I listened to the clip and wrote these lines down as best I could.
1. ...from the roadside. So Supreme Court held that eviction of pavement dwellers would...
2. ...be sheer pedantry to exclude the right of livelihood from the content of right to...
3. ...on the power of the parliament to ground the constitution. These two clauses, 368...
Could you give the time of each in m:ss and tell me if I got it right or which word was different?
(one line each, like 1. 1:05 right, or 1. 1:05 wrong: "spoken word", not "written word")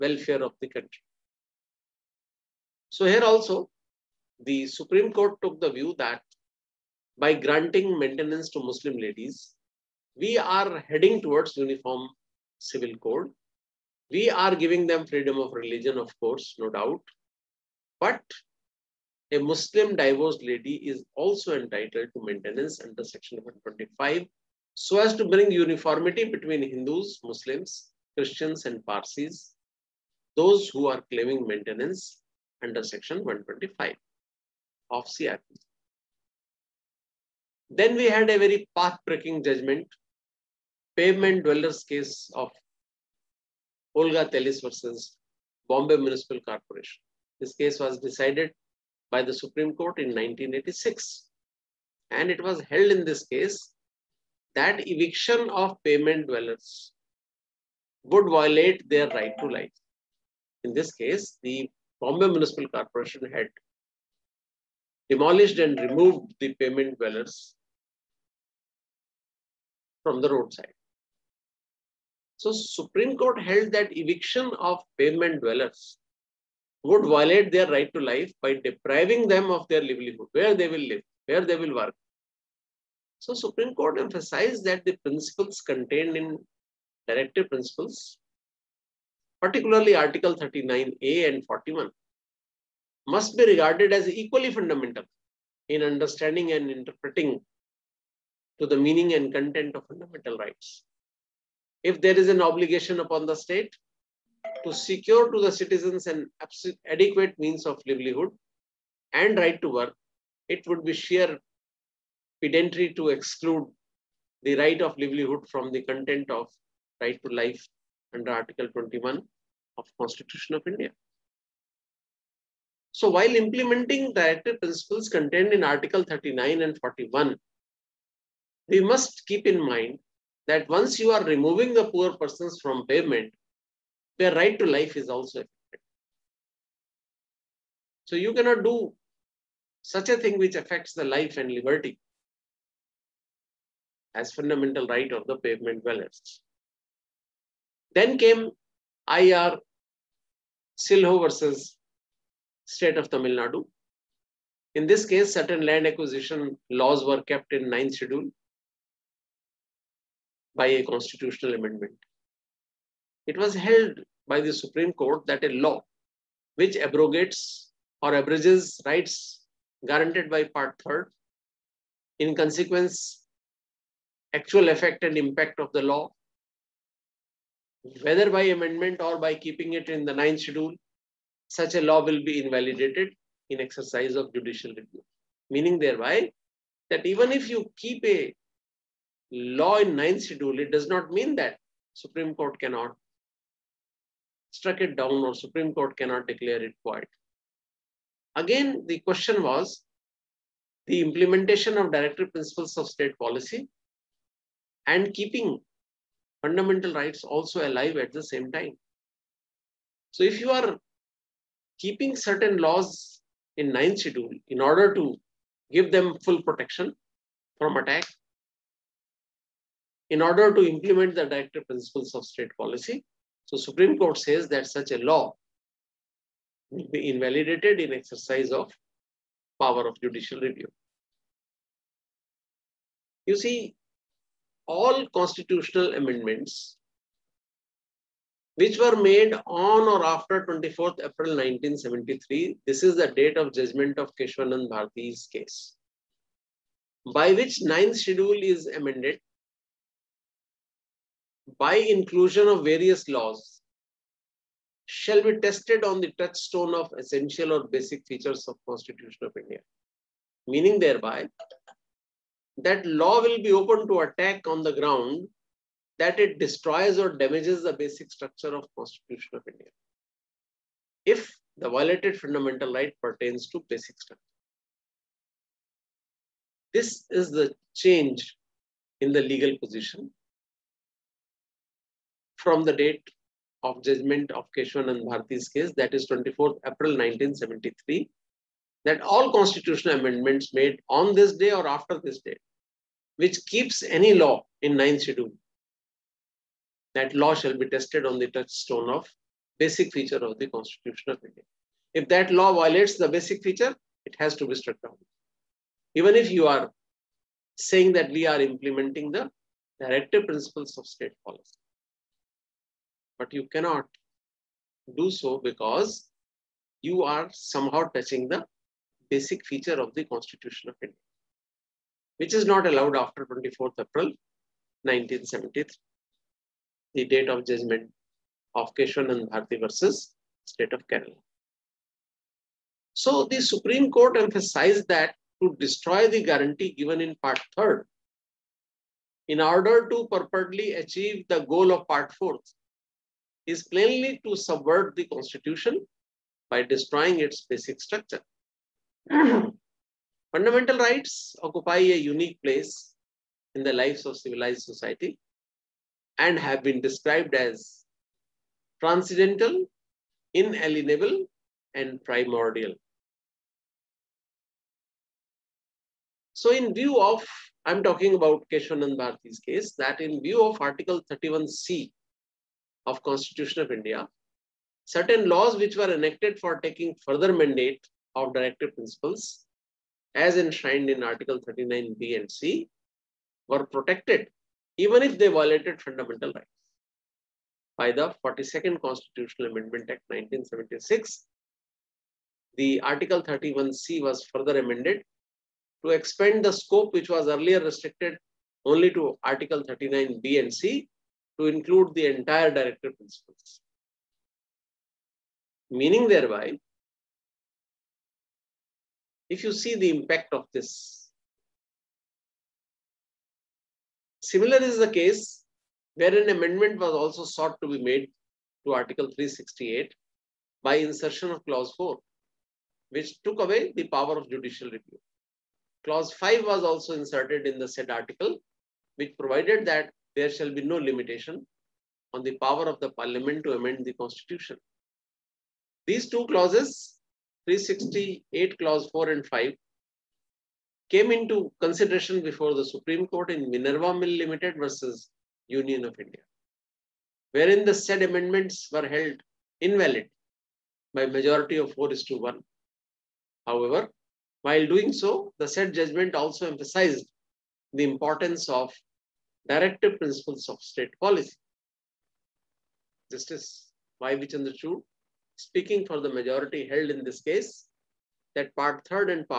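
1. 1:10 right
2. 1:50 right
3. 7:12 wrong: "amend", not "ground".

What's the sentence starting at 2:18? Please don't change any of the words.
So you cannot do such a thing which affects the life and liberty as fundamental right of the pavement dwellers.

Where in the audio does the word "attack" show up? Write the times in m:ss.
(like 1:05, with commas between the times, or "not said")
3:37, 4:24.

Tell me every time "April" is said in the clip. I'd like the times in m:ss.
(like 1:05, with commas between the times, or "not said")
4:01, 4:46, 5:23.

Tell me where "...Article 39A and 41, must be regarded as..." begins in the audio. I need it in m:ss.
1:29.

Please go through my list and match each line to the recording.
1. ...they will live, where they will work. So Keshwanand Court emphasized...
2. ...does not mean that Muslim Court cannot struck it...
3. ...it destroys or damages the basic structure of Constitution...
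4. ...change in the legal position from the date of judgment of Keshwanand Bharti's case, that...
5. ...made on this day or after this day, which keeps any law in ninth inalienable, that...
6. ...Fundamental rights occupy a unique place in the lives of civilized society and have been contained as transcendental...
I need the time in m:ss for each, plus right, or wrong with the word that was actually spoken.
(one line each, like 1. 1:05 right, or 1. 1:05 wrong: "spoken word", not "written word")
1. 1:20 wrong: "Supreme", not "Keshwanand"
2. 3:10 wrong: "Supreme", not "Muslim"
3. 4:26 right
4. 4:37 right
5. 4:50 wrong: "schedule", not "inalienable"
6. 5:50 wrong: "described", not "contained".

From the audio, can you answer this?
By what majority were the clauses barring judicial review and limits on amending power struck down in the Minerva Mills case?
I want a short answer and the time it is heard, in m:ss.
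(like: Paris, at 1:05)
4 to 1, at 7:31.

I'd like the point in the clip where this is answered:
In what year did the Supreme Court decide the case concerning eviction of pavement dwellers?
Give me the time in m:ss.
0:50.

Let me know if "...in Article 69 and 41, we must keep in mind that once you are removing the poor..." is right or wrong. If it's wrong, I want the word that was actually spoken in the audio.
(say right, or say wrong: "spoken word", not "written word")
wrong: "39", not "69".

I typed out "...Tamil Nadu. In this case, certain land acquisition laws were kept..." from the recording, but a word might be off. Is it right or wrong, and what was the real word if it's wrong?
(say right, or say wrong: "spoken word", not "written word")
right.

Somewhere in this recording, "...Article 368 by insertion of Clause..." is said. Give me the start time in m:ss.
6:58.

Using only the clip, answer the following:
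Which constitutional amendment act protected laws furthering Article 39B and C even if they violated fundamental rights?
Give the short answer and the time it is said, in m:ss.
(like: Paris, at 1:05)
42nd Constitutional Amendment Act 1976, at 6:28.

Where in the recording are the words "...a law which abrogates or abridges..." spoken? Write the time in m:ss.
2:45.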